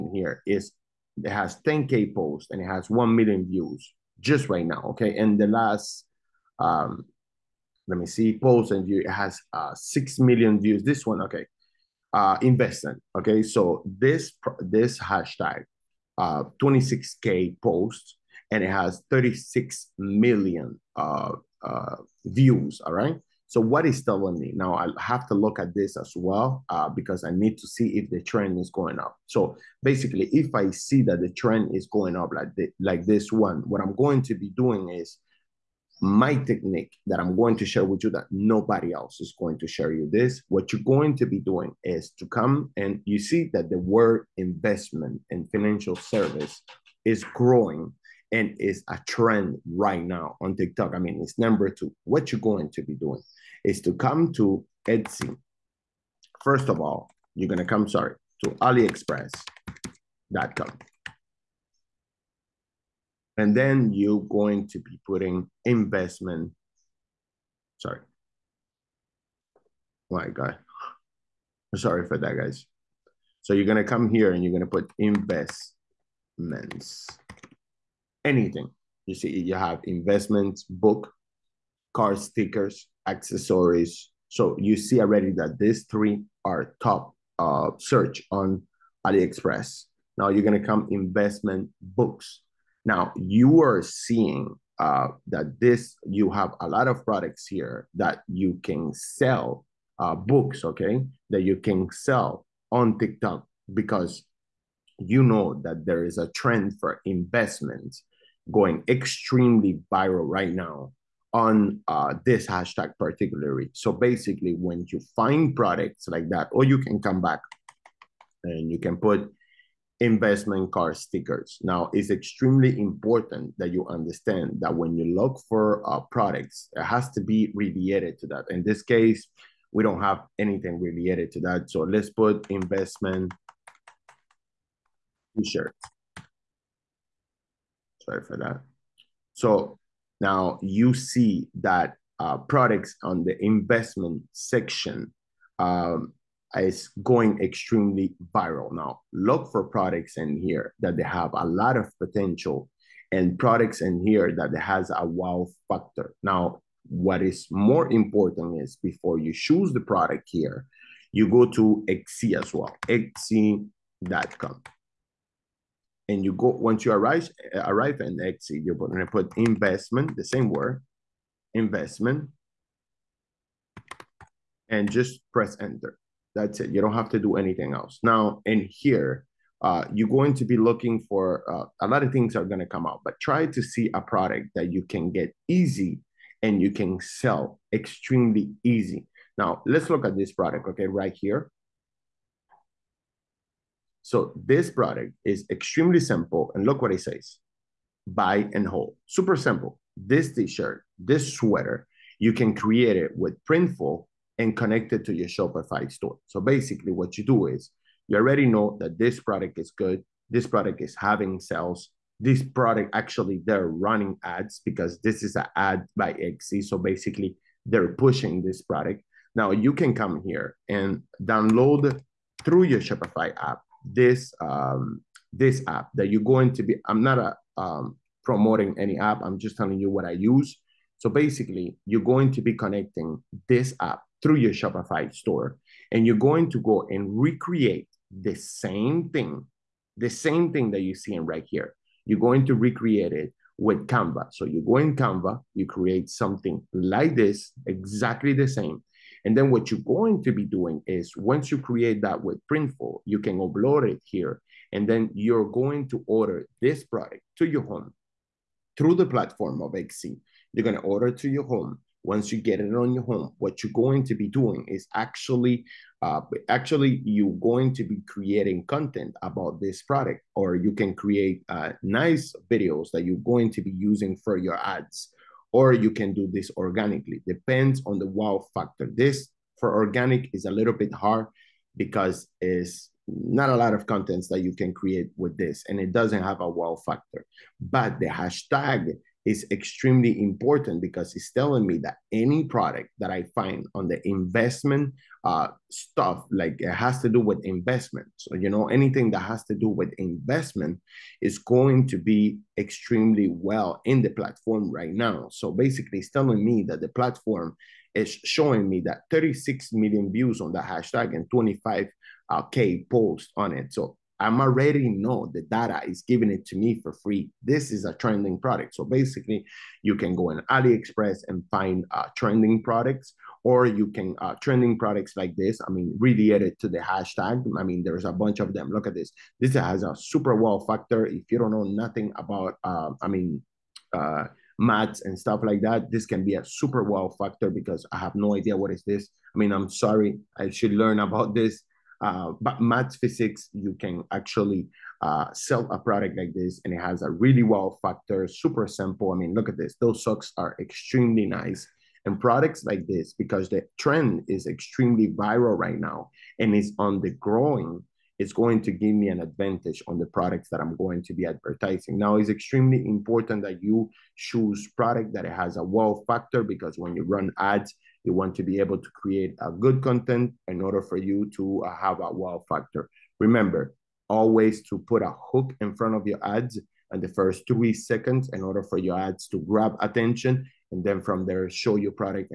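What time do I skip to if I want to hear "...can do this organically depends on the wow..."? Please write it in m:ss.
4:35.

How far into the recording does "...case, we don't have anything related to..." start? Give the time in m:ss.
2:08.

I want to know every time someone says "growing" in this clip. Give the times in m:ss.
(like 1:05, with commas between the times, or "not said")
0:47, 5:57.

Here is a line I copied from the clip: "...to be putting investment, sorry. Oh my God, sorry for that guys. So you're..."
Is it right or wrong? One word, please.
right.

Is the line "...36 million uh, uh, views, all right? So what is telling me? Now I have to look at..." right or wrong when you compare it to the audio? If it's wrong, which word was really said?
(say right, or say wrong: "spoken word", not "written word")
right.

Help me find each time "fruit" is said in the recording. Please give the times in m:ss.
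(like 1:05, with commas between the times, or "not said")
not said.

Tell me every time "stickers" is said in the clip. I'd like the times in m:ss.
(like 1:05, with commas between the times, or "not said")
1:22, 2:00.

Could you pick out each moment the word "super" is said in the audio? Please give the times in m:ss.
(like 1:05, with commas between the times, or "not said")
3:19, 5:29, 5:36, 5:48.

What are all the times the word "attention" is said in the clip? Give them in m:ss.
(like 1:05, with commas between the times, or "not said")
6:19.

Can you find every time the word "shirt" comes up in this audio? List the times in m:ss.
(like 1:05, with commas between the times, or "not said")
2:15, 3:20.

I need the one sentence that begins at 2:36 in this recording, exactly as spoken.
Now, what is more important is before you choose the product here, you go to Etsy as well, Etsy.com.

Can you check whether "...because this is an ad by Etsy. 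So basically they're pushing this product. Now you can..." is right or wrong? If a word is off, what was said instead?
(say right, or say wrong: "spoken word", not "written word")
right.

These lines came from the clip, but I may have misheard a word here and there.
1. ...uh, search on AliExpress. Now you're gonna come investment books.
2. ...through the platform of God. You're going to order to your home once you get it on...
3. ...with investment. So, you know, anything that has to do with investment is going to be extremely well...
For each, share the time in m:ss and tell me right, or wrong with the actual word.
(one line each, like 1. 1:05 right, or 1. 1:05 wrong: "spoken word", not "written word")
1. 1:27 right
2. 4:18 wrong: "Etsy", not "God"
3. 4:57 right.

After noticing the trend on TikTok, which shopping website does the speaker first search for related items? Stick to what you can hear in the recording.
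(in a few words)
AliExpress.com.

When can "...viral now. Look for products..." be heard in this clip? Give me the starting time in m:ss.
2:28.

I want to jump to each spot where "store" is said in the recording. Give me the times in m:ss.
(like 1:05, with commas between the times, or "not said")
3:25, 3:55.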